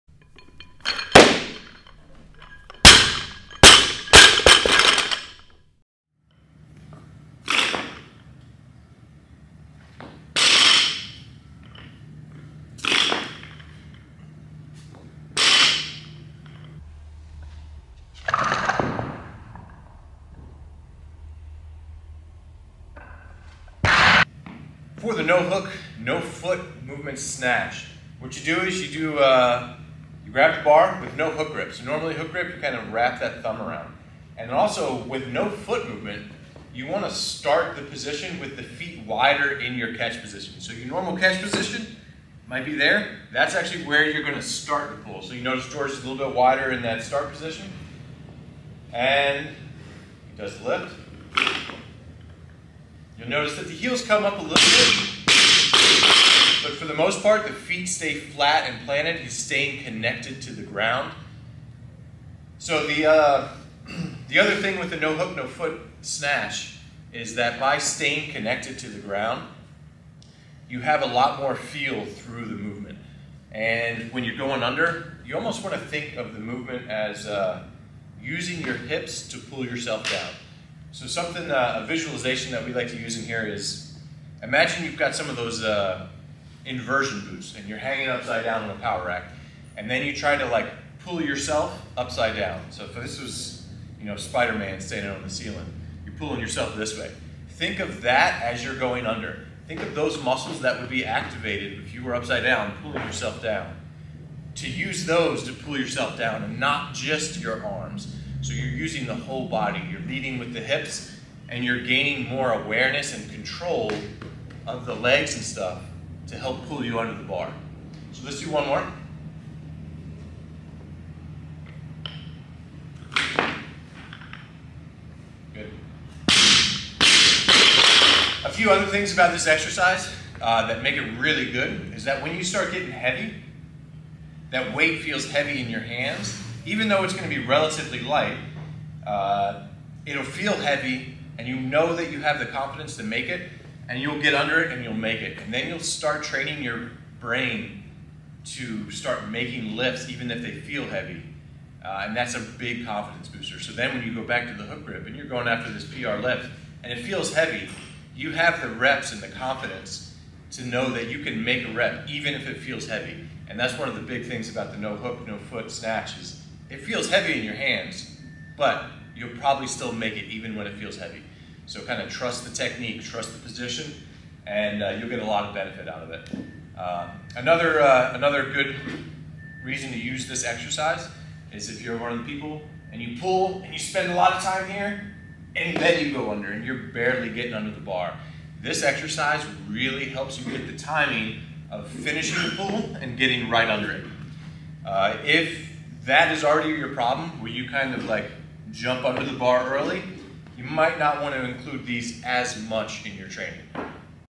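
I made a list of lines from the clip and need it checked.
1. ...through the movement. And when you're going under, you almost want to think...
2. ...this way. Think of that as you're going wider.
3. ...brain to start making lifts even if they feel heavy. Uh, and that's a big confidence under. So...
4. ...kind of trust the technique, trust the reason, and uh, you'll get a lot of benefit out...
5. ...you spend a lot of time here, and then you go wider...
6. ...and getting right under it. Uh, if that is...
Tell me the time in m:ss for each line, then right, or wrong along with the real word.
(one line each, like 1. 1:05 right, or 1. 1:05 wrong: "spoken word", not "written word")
1. 1:12 right
2. 1:36 wrong: "under", not "wider"
3. 2:27 wrong: "booster", not "under"
4. 2:51 wrong: "position", not "reason"
5. 3:03 wrong: "under", not "wider"
6. 3:13 right.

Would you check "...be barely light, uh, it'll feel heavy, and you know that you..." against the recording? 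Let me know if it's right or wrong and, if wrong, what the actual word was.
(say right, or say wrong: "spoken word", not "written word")
wrong: "relatively", not "barely".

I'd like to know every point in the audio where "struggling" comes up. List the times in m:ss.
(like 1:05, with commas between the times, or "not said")
not said.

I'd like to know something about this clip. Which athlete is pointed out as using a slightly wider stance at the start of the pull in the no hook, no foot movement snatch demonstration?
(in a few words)
George.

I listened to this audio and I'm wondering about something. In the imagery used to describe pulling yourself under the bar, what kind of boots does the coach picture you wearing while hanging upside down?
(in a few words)
inversion boots.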